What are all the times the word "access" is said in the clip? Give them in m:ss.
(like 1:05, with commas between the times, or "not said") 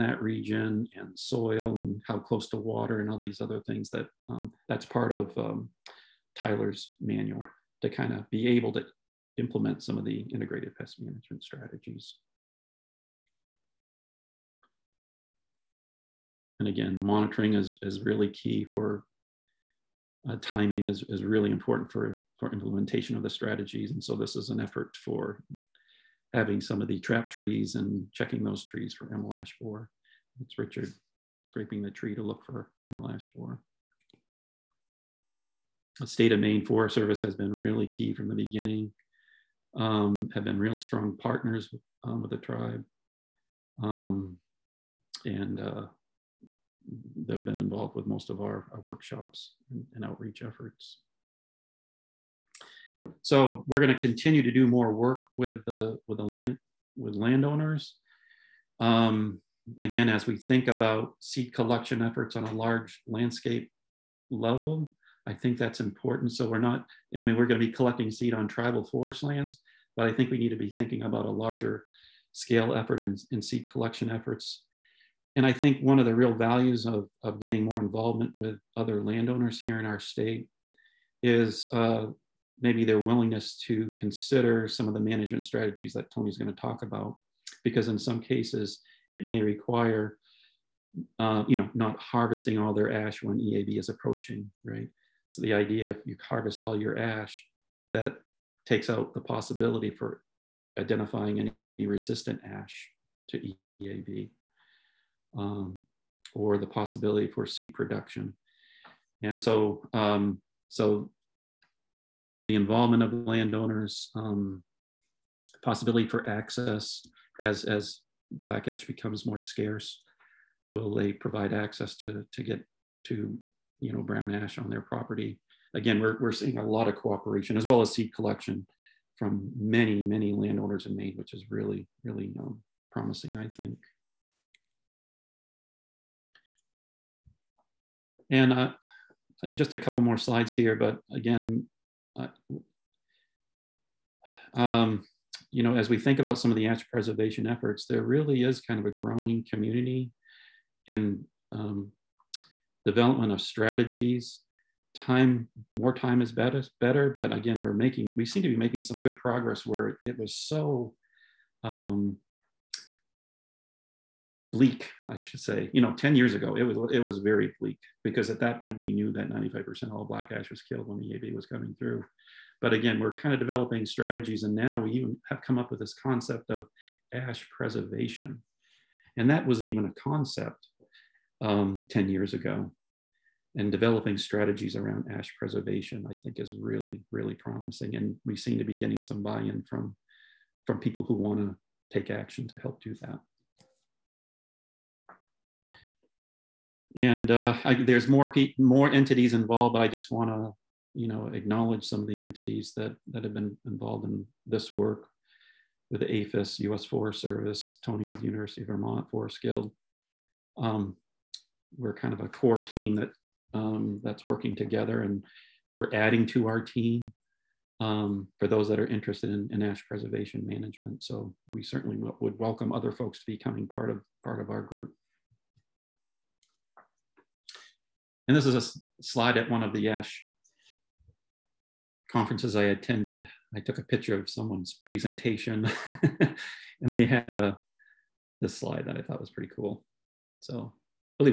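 1:56, 2:01.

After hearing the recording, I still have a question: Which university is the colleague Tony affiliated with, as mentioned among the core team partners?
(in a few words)
University of Vermont.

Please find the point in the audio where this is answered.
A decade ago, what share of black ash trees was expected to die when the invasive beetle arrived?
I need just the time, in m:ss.
2:49.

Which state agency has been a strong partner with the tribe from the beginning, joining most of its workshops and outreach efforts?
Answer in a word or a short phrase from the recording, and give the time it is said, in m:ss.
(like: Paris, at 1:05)
Maine Forest Service, at 0:36.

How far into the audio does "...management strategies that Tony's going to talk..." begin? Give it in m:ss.
1:24.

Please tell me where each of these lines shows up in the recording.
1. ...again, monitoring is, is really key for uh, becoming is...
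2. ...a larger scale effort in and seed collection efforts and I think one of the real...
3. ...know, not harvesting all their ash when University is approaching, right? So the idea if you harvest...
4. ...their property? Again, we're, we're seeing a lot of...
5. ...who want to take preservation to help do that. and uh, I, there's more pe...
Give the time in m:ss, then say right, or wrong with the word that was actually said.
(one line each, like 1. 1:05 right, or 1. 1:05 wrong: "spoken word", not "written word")
1. 0:16 wrong: "timing", not "becoming"
2. 1:11 right
3. 1:31 wrong: "EAB", not "University"
4. 2:04 right
5. 3:11 wrong: "action", not "preservation".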